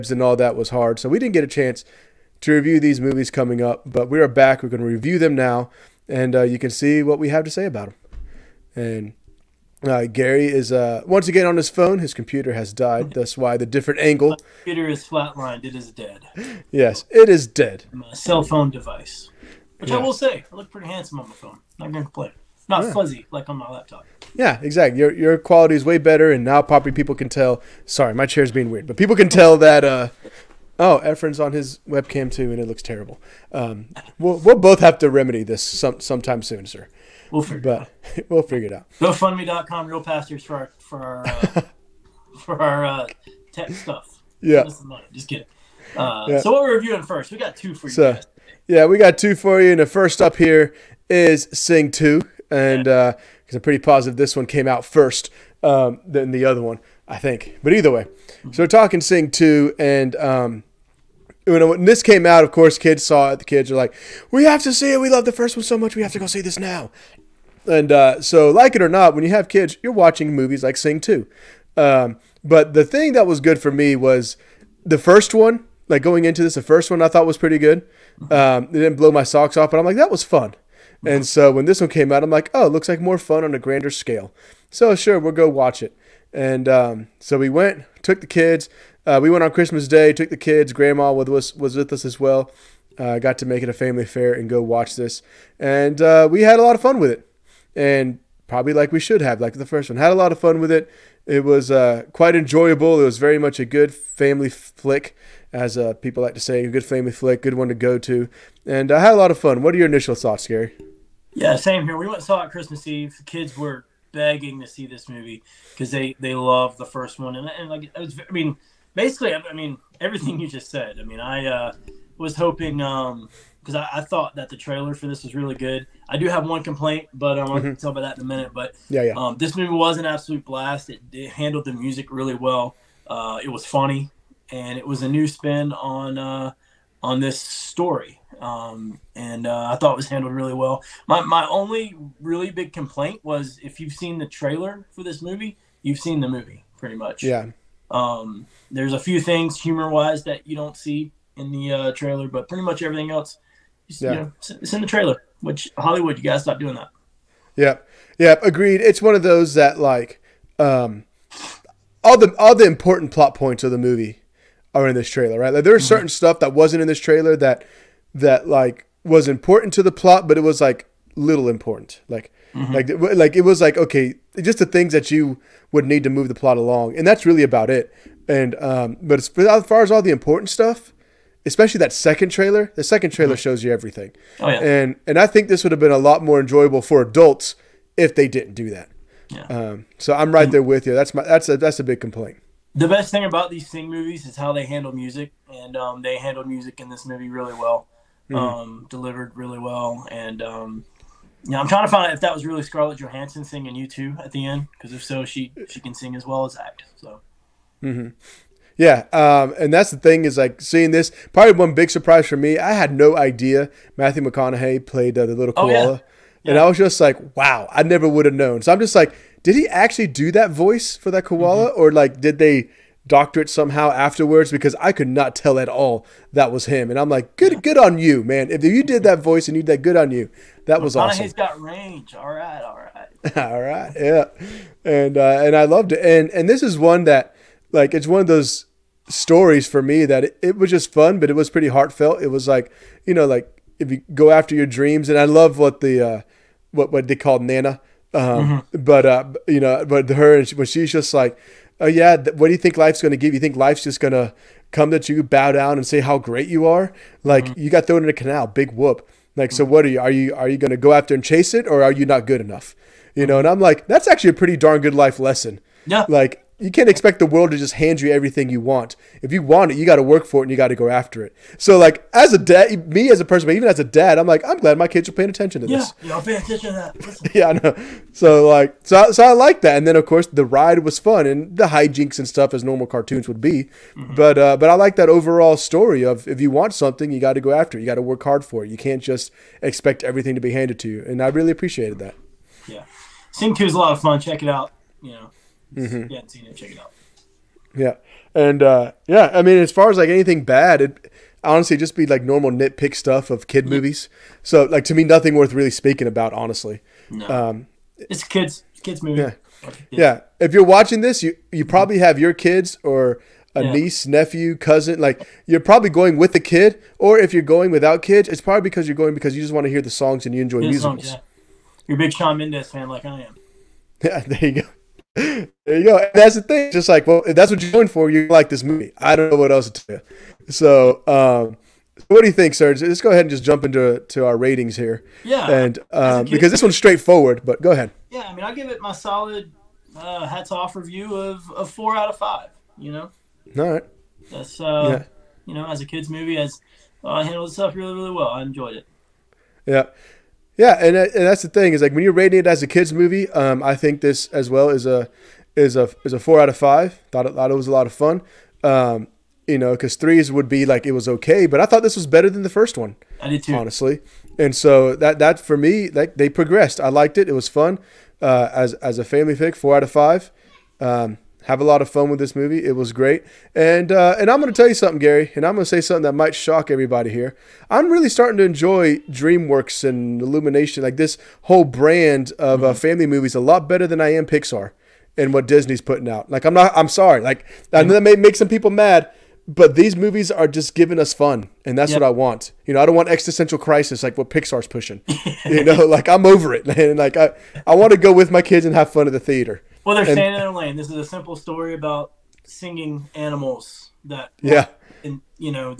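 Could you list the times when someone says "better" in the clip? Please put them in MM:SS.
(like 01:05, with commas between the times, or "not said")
00:25, 06:02, 06:23.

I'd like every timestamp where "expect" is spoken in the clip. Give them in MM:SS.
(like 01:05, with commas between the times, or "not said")
04:26, 04:49.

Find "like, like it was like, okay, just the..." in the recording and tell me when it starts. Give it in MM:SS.
02:52.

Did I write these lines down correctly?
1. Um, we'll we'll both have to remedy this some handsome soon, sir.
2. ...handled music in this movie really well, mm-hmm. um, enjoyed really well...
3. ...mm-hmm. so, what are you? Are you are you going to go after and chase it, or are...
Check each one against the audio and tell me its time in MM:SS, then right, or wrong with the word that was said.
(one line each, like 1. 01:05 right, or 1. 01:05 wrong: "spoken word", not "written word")
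1. 00:33 wrong: "sometime", not "handsome"
2. 03:16 wrong: "delivered", not "enjoyed"
3. 04:19 right.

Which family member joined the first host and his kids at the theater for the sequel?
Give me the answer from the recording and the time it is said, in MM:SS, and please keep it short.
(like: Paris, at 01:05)
Grandma, at 01:30.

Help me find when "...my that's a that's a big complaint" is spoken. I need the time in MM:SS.
03:11.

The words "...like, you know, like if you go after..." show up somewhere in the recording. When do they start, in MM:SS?
04:02.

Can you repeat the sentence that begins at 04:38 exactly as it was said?
So, like, so, so I like that.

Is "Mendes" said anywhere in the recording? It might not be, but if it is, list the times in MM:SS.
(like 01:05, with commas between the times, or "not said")
05:22.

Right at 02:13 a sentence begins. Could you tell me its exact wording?
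Uh, it was funny, and it was a new spin on uh, on this story.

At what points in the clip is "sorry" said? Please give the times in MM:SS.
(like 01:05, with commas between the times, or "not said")
00:27, 06:26.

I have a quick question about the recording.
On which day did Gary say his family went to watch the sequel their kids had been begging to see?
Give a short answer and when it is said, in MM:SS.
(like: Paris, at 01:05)
Christmas Eve, at 01:52.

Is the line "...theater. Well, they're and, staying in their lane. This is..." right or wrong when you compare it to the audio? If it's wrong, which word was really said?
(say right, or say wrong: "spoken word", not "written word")
right.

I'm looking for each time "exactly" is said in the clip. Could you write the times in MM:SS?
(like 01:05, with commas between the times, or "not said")
00:24.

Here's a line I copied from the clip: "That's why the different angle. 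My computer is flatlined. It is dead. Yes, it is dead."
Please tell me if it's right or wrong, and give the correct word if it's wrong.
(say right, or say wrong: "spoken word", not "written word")
right.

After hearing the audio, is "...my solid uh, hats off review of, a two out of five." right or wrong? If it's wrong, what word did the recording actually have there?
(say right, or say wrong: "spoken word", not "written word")
wrong: "four", not "two".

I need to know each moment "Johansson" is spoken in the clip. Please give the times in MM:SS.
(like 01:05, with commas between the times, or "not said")
03:22.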